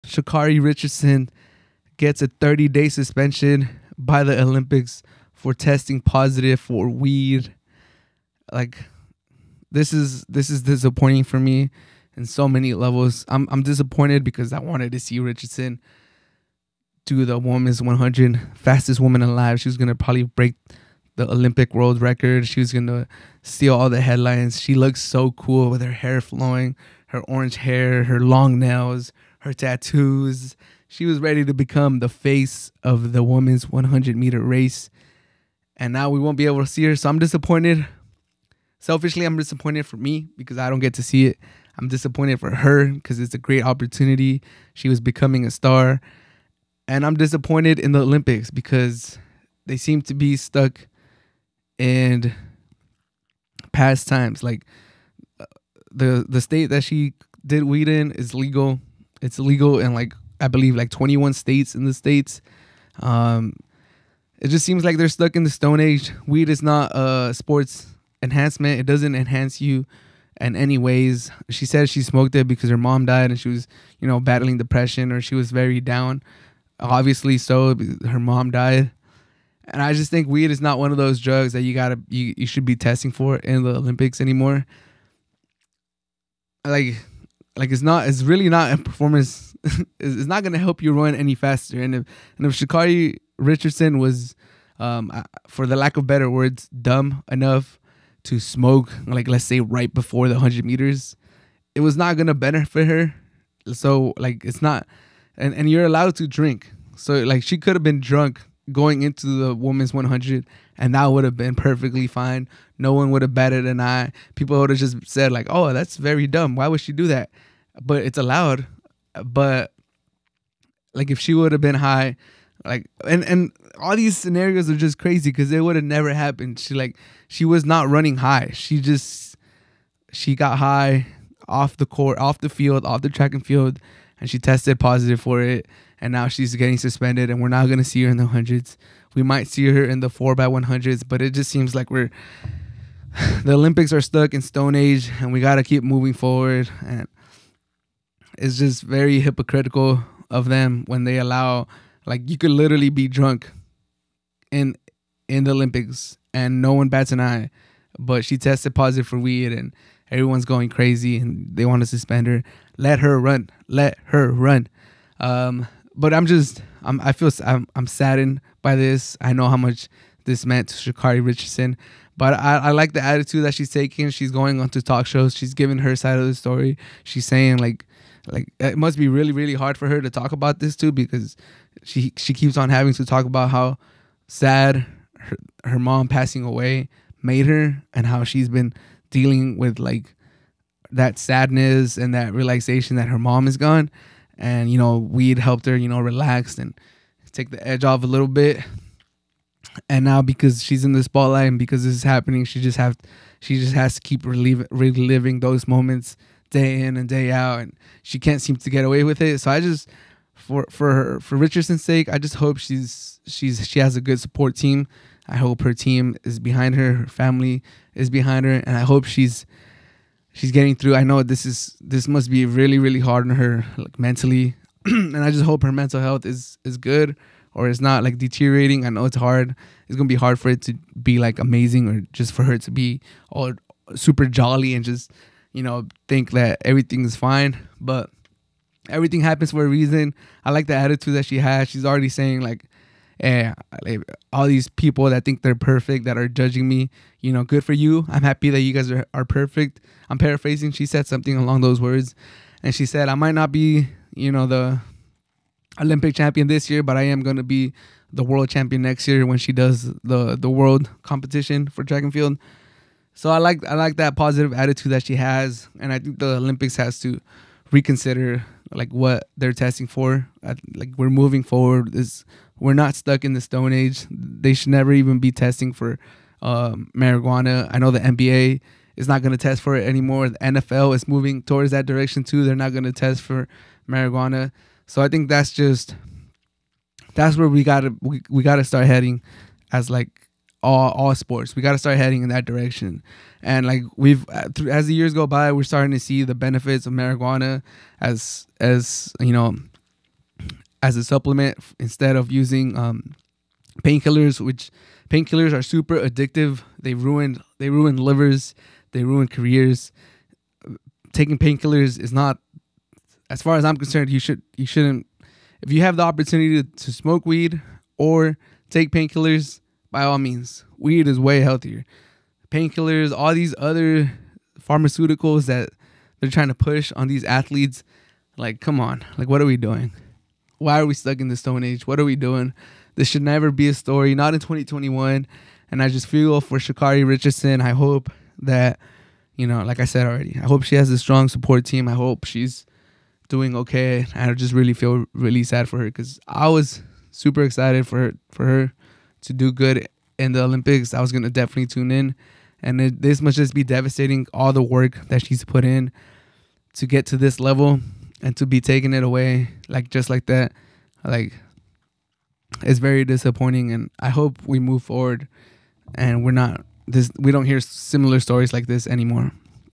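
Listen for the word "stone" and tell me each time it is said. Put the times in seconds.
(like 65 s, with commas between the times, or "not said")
65 s, 144 s, 273 s, 331 s.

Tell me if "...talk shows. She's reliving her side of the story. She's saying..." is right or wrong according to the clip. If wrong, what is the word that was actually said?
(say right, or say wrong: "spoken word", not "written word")
wrong: "giving", not "reliving".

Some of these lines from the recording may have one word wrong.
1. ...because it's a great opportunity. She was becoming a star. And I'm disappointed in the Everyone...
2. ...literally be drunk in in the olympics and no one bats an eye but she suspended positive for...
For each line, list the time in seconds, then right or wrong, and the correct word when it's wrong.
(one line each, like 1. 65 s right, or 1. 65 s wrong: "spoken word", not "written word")
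1. 42 s wrong: "Olympics", not "Everyone"
2. 152 s wrong: "tested", not "suspended".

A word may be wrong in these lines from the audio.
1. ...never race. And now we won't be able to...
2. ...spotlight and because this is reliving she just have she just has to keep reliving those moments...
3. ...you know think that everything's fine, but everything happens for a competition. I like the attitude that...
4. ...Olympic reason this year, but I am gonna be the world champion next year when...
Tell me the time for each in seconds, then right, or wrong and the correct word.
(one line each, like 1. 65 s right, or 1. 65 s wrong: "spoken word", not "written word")
1. 34 s wrong: "meter", not "never"
2. 201 s wrong: "happening", not "reliving"
3. 235 s wrong: "reason", not "competition"
4. 255 s wrong: "champion", not "reason".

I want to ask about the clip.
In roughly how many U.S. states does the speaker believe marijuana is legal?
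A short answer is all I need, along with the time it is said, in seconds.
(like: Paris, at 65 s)
21, at 60 s.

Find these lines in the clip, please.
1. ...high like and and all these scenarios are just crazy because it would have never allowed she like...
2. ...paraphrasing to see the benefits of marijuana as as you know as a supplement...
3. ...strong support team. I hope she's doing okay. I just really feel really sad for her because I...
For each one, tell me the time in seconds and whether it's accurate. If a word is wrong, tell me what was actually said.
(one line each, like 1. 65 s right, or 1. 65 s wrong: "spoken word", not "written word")
1. 121 s wrong: "happened", not "allowed"
2. 295 s wrong: "starting", not "paraphrasing"
3. 340 s right.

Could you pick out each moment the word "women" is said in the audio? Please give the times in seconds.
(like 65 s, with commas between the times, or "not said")
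17 s, 33 s, 109 s.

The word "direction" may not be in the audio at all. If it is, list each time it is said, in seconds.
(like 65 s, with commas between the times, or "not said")
281 s, 292 s.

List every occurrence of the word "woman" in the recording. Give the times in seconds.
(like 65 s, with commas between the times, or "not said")
18 s.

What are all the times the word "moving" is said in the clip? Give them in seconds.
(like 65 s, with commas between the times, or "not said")
145 s, 271 s, 281 s.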